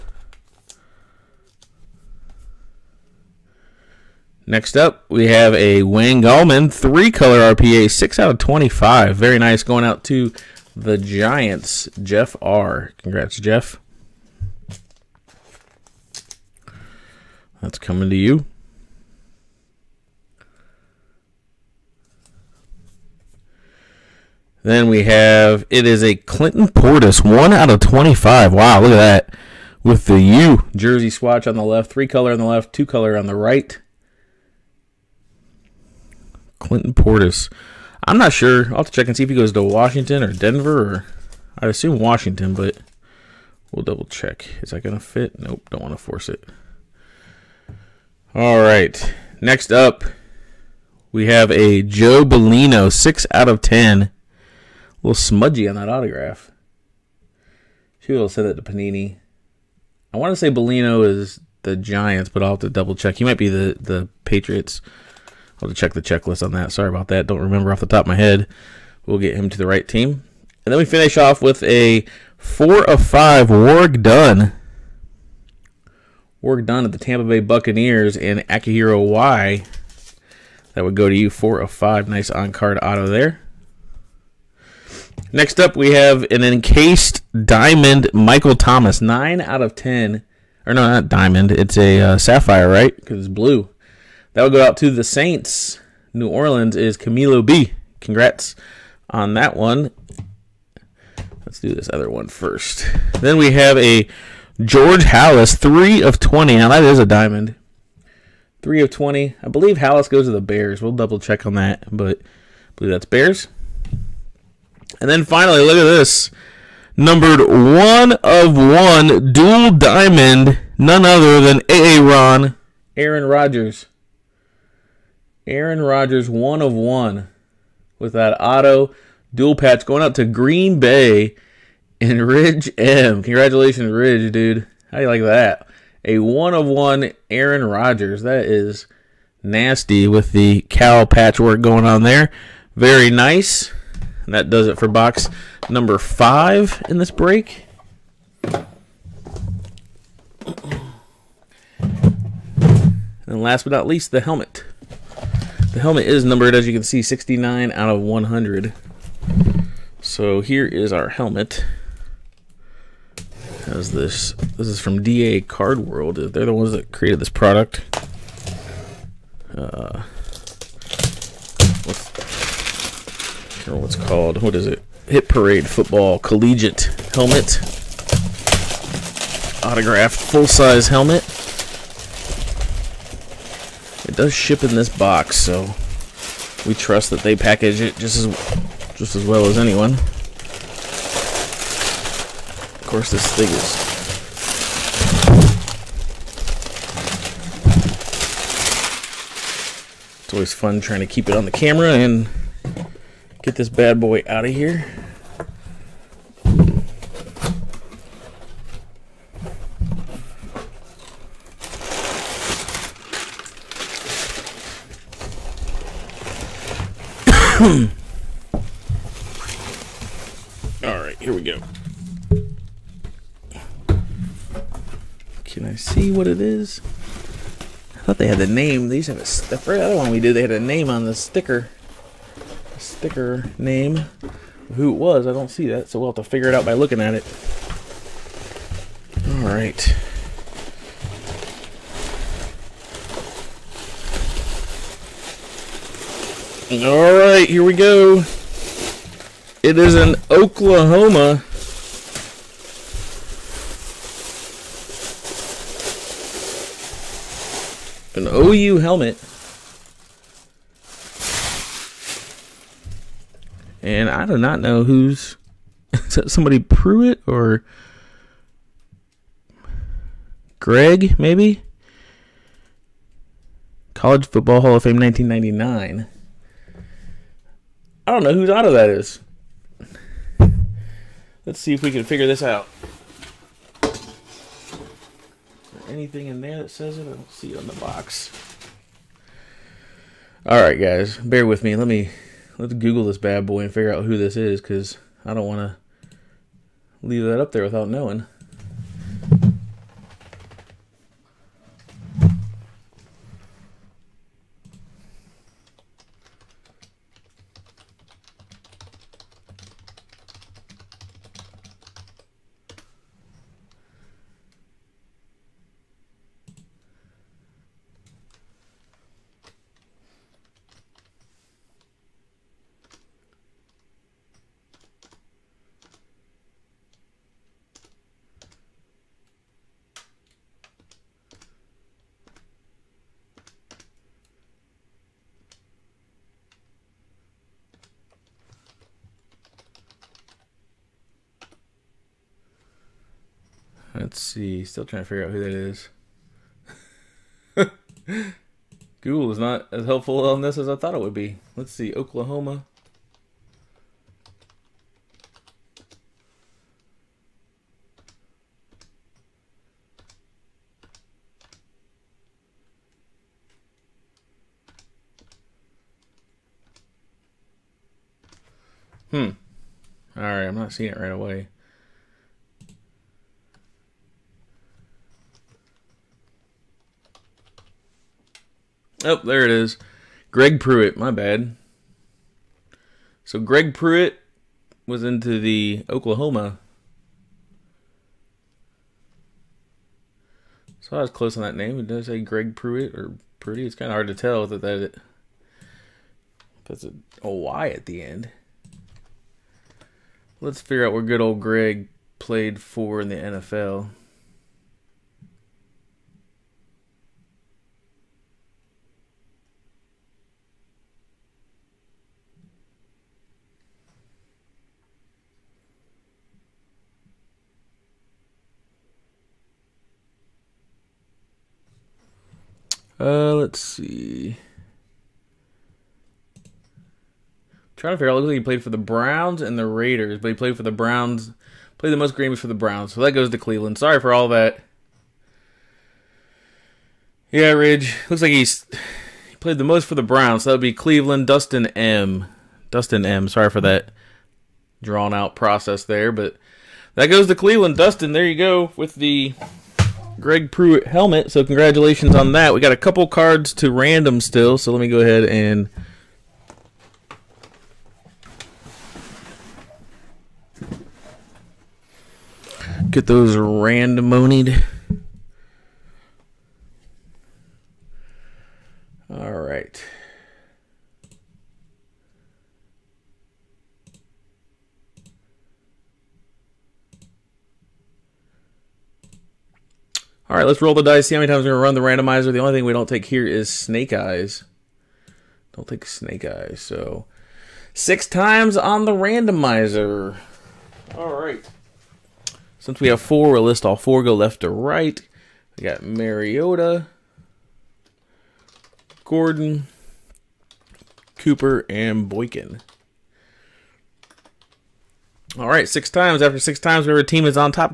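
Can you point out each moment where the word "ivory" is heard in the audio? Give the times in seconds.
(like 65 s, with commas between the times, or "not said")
not said.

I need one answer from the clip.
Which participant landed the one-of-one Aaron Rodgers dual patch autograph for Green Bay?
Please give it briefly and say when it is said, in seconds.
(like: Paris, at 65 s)
Ridge M., at 132 s.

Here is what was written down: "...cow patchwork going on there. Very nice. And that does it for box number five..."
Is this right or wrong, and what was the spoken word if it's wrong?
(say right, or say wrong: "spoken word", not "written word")
right.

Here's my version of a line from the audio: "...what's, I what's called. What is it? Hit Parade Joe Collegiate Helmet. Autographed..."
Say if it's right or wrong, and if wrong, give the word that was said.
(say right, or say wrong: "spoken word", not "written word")
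wrong: "Football", not "Joe".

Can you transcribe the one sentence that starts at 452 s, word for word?
We got a couple cards to random still.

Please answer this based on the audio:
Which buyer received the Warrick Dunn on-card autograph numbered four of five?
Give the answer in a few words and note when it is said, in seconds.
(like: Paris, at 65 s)
Akihiro Y., at 78 s.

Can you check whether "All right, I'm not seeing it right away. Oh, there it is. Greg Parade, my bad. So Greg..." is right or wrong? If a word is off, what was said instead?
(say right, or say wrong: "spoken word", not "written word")
wrong: "Pruitt", not "Parade".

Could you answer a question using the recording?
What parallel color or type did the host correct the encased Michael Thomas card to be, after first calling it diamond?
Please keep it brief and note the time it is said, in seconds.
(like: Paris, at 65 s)
Sapphire, at 92 s.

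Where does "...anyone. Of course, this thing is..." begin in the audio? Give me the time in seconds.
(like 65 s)
189 s.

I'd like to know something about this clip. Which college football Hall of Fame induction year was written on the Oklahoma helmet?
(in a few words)
1999.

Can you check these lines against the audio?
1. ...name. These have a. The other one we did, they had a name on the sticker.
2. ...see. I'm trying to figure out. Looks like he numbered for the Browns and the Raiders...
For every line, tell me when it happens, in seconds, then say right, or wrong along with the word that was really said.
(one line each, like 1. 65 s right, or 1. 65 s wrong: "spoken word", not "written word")
1. 228 s right
2. 423 s wrong: "played", not "numbered".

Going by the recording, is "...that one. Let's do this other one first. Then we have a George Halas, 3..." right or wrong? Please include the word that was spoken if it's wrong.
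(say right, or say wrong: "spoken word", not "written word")
right.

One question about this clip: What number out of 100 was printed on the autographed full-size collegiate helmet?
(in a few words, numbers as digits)
69.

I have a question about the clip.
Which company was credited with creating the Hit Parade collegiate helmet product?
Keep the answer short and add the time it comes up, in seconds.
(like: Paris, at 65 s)
DA Card World, at 165 s.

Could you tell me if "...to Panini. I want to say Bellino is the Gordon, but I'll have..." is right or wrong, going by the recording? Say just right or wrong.
wrong.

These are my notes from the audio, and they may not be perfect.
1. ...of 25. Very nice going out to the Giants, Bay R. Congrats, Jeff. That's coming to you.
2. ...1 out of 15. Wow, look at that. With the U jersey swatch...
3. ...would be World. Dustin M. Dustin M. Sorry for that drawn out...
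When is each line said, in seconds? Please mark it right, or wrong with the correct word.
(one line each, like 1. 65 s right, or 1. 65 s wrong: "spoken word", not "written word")
1. 8 s wrong: "Jeff", not "Bay"
2. 27 s wrong: "25", not "15"
3. 440 s wrong: "Cleveland", not "World".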